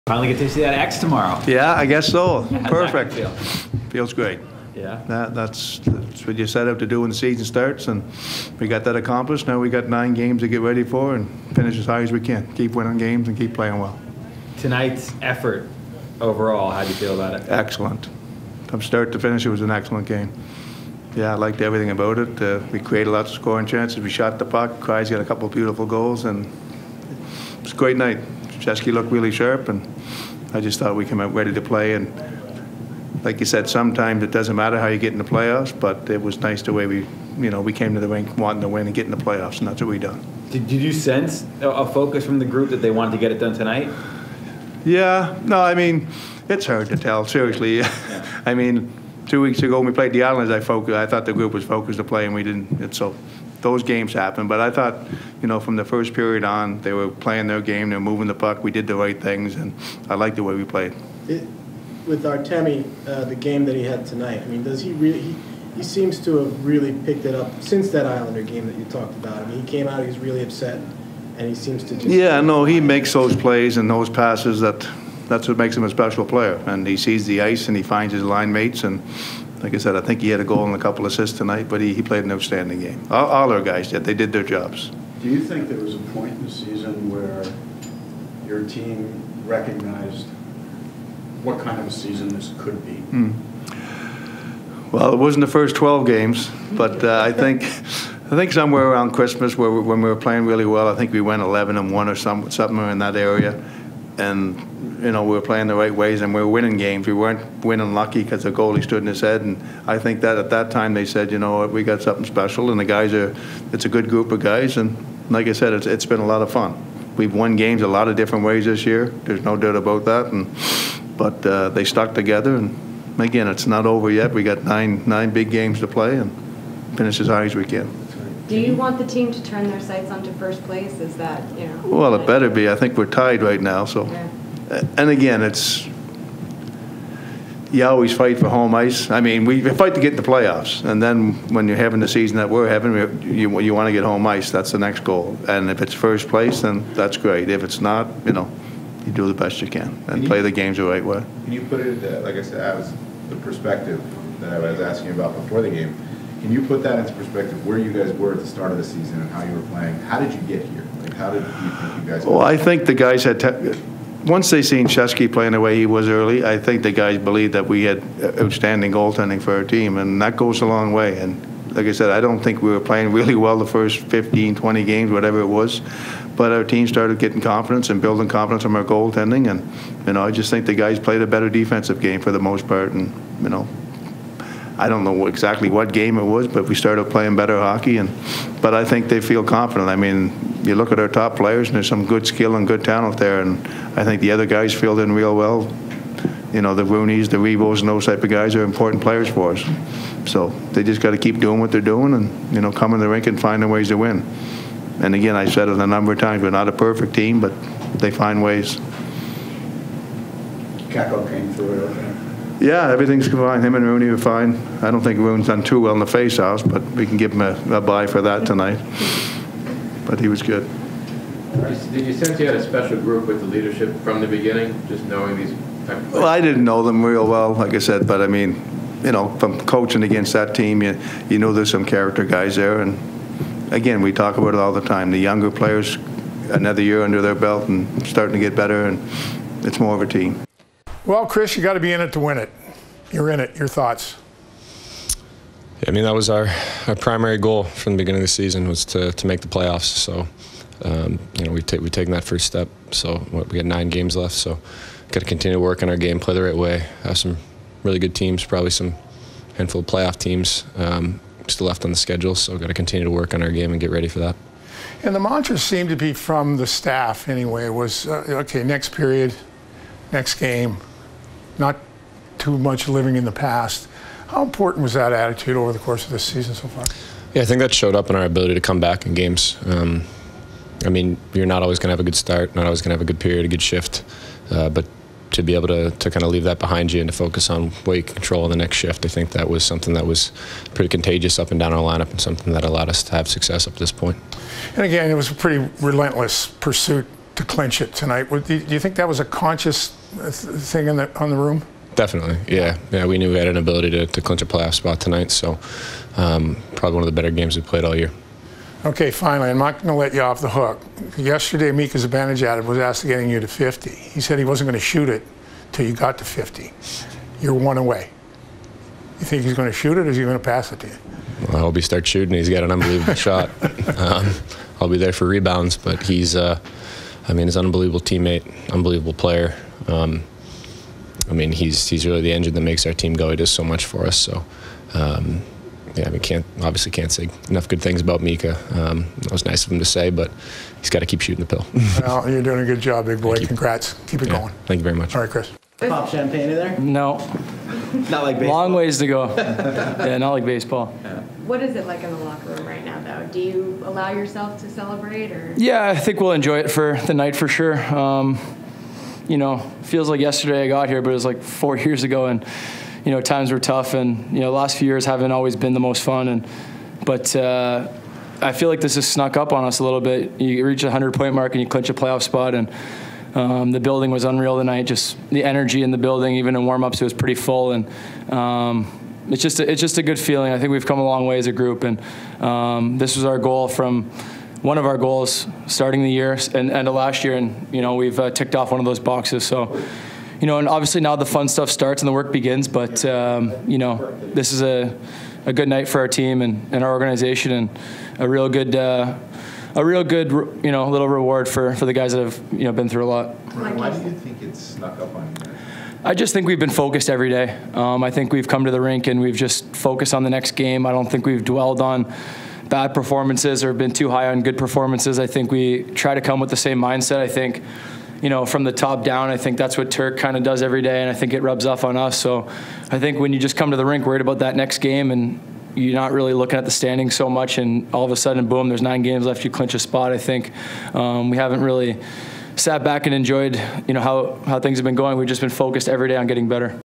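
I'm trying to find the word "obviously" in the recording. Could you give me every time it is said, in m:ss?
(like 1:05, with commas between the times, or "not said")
5:36, 6:30.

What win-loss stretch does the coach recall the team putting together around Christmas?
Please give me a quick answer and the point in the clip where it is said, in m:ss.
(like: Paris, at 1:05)
11 and 1, at 1:41.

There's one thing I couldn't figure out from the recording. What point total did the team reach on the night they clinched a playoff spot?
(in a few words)
100.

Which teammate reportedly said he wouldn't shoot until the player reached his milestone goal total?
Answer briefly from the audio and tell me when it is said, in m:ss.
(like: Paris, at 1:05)
Mika Zibanejad, at 5:11.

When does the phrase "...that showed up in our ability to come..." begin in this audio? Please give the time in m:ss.
4:37.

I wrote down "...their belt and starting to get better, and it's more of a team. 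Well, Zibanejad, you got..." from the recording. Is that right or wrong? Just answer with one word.
wrong.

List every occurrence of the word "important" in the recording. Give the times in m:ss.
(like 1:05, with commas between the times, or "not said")
3:18, 4:34.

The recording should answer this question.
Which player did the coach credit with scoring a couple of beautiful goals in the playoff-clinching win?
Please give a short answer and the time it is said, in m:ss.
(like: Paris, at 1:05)
Kreids, at 0:24.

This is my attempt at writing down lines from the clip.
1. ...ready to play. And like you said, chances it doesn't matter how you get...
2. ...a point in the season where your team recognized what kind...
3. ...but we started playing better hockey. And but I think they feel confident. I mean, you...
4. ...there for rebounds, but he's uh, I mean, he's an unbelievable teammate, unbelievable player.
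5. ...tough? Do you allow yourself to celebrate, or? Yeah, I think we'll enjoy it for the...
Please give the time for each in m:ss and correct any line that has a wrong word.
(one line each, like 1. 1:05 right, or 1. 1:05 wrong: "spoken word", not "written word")
1. 0:31 wrong: "sometimes", not "chances"
2. 1:25 right
3. 3:06 right
4. 5:24 right
5. 5:53 wrong: "though", not "tough".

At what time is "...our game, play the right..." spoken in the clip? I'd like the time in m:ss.
4:15.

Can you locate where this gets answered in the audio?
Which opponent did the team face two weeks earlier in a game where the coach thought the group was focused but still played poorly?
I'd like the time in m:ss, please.
0:50.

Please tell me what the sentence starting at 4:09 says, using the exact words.
So, um, you know, we've, ta- we've taken that first step.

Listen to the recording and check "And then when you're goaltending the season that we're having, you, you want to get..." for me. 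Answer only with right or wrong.
wrong.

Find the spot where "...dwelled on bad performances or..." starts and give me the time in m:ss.
6:51.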